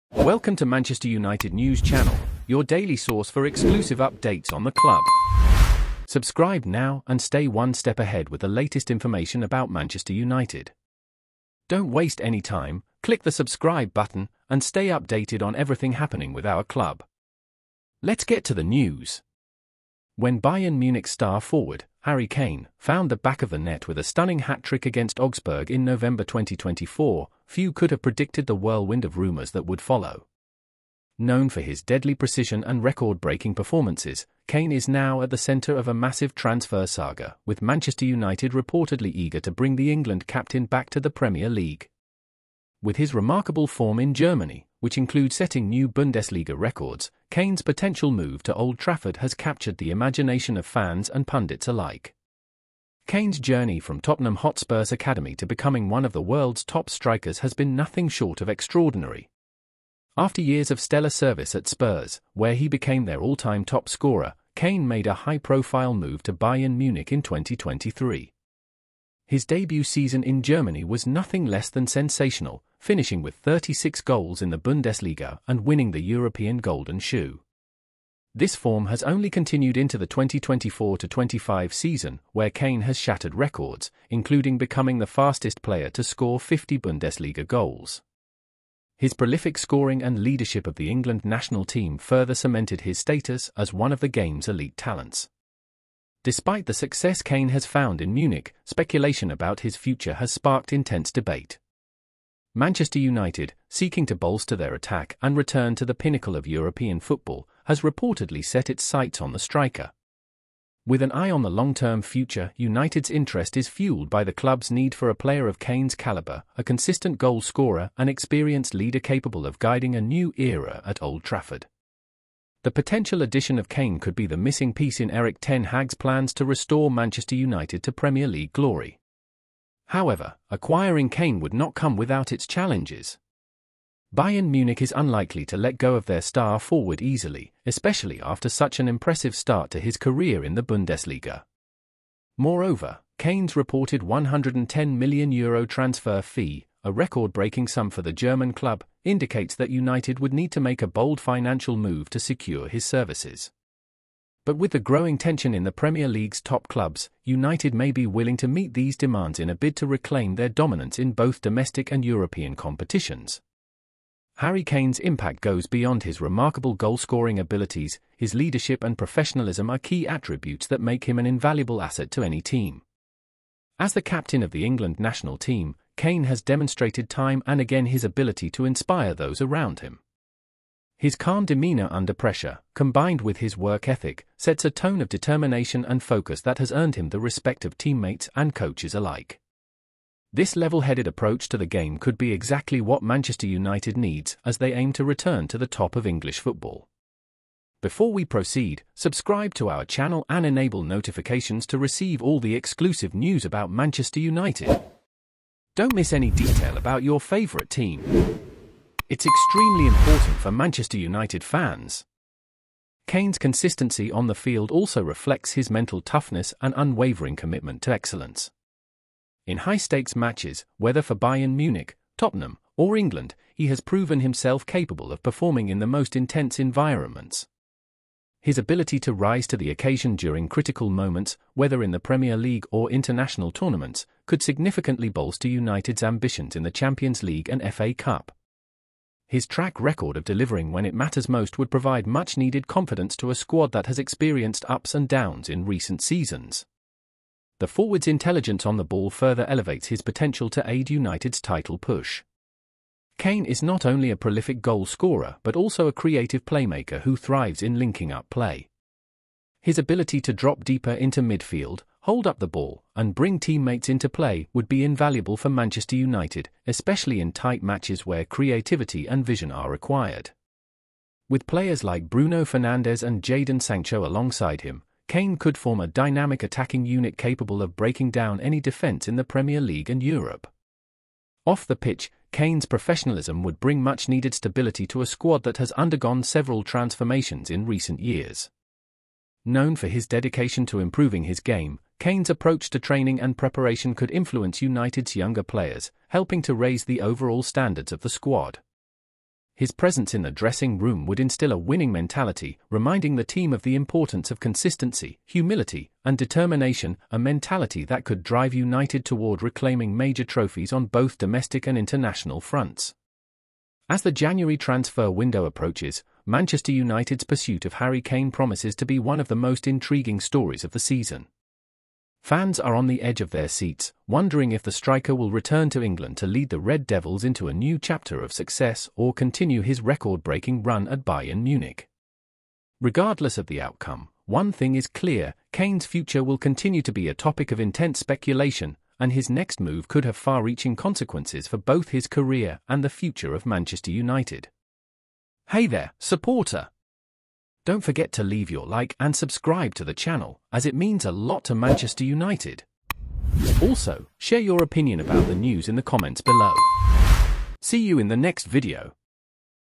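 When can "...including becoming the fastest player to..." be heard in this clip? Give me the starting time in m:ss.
1:24.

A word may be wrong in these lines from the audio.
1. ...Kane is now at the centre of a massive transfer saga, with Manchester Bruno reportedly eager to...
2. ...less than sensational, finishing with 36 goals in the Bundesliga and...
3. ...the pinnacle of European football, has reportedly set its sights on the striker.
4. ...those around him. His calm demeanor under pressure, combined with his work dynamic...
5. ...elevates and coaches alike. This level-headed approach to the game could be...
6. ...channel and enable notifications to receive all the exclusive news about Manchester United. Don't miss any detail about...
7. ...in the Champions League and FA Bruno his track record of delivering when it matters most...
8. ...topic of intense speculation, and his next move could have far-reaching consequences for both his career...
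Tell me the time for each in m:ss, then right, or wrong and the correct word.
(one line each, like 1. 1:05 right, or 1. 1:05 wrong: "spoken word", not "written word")
1. 0:34 wrong: "United", not "Bruno"
2. 1:11 right
3. 1:45 right
4. 2:59 wrong: "ethic", not "dynamic"
5. 3:07 wrong: "teammates", not "elevates"
6. 3:19 right
7. 3:56 wrong: "Cup", not "Bruno"
8. 5:37 right.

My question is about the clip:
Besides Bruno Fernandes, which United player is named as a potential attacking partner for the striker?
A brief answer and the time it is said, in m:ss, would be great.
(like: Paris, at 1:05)
Jadon Sancho, at 4:33.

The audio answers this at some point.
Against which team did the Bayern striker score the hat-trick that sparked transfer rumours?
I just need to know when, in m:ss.
0:25.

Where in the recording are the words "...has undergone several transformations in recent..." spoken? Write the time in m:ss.
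4:45.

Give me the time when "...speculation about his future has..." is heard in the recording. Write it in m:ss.
1:38.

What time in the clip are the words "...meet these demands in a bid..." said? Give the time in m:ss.
2:38.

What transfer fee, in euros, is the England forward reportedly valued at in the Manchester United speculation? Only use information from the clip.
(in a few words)
€110 million.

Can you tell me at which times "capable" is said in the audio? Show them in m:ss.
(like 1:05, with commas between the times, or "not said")
1:58, 3:44, 4:37.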